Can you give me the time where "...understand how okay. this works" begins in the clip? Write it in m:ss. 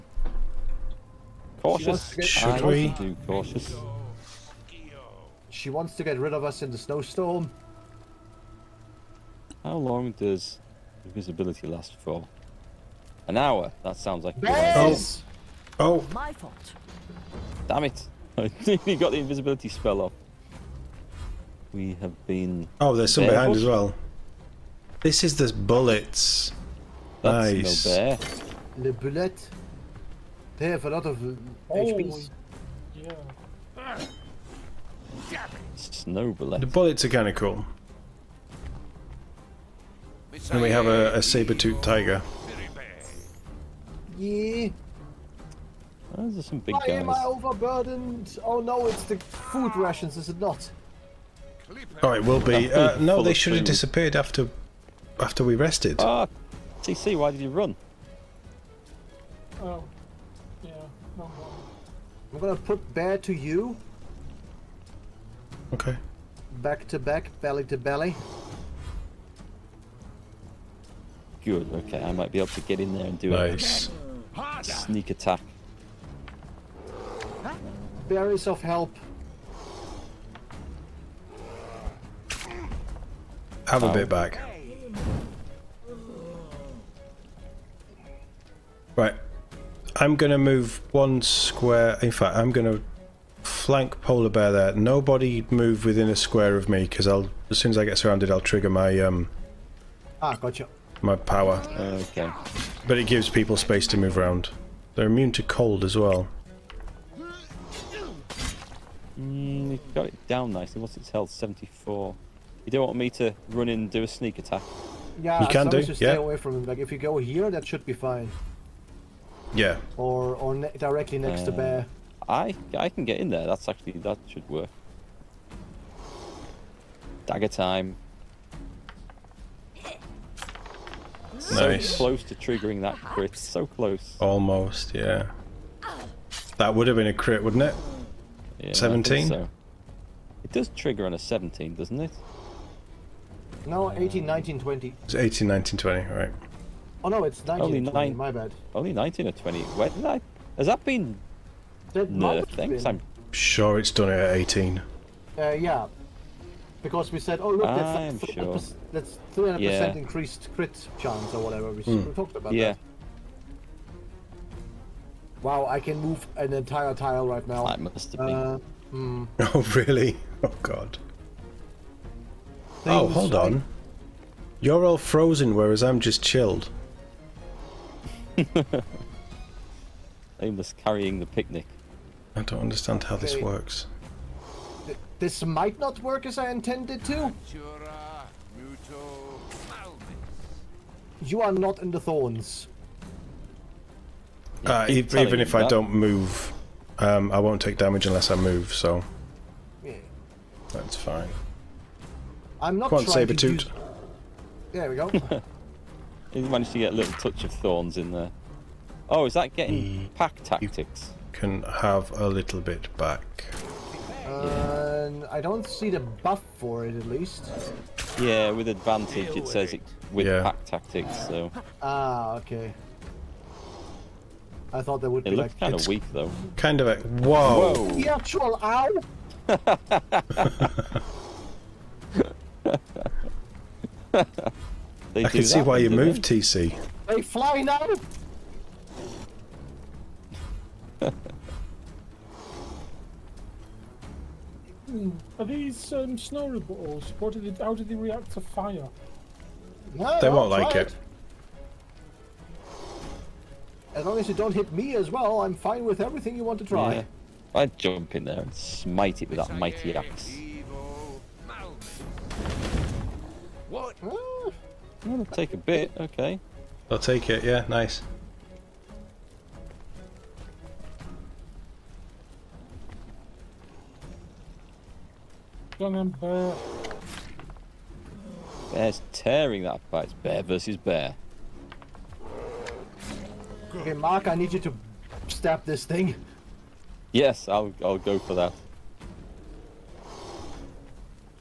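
3:02.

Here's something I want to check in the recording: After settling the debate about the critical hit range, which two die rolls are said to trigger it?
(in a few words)
19 or 20.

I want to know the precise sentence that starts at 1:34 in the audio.
Nobody move within a square of me because I'll as soon as I get surrounded, I'll trigger my um.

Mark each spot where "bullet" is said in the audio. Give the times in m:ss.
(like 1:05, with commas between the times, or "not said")
0:28, 0:36.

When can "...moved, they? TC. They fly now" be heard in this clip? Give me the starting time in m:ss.
3:55.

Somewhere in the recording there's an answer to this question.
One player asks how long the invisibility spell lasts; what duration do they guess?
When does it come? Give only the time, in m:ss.
0:13.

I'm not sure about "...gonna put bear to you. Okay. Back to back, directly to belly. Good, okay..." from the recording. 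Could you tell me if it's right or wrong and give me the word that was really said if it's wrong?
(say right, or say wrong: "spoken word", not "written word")
wrong: "belly", not "directly".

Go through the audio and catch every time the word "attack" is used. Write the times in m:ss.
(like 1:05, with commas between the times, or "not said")
1:15, 1:54.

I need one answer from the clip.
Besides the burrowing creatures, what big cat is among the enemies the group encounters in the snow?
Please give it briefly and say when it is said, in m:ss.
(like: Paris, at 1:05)
Saber-toothed tiger, at 0:41.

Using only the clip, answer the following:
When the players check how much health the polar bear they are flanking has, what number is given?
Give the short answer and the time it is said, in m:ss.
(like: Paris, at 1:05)
74, at 1:51.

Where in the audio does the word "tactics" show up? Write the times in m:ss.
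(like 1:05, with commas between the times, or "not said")
3:30, 3:40.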